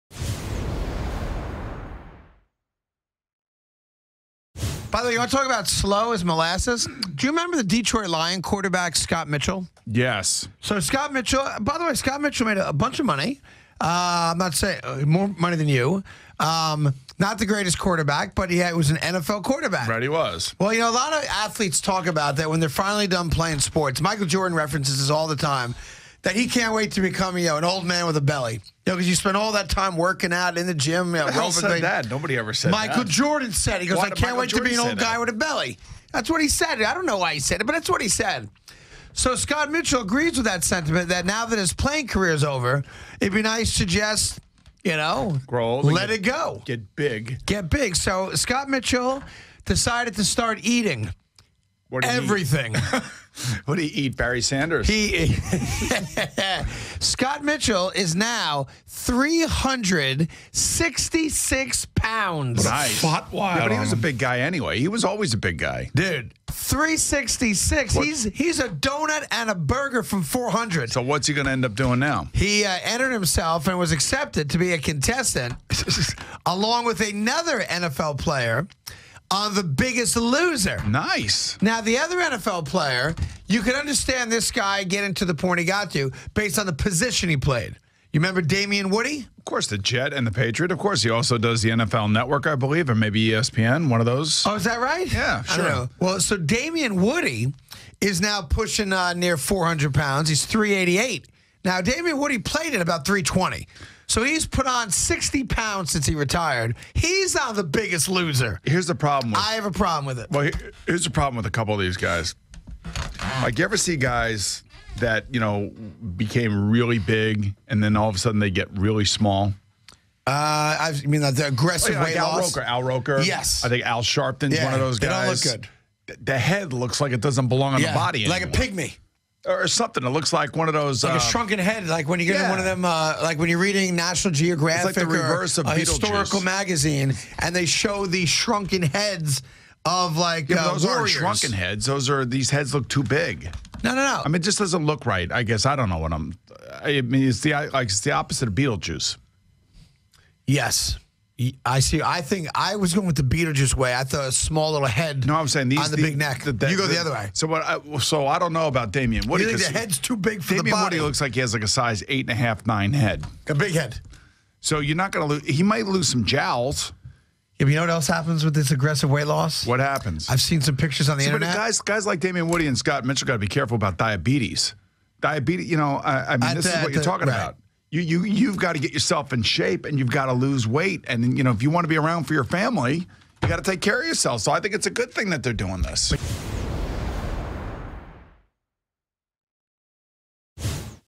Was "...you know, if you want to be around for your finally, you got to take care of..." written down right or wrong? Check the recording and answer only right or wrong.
wrong.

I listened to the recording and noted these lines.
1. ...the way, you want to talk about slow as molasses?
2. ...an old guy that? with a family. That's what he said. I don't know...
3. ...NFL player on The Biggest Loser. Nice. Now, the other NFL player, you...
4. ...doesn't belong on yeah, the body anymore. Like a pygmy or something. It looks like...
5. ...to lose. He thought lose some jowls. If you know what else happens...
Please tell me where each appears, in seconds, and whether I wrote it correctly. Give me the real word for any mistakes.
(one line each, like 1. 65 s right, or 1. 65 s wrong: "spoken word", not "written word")
1. 5 s right
2. 34 s wrong: "belly", not "family"
3. 77 s right
4. 127 s right
5. 165 s wrong: "might", not "thought".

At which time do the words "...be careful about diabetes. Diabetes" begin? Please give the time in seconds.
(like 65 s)
173 s.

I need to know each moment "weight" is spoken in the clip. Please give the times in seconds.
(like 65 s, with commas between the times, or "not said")
122 s, 169 s, 180 s.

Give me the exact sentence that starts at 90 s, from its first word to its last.
Of course, he also does the NFL Network, I believe, or maybe ESPN, one of those.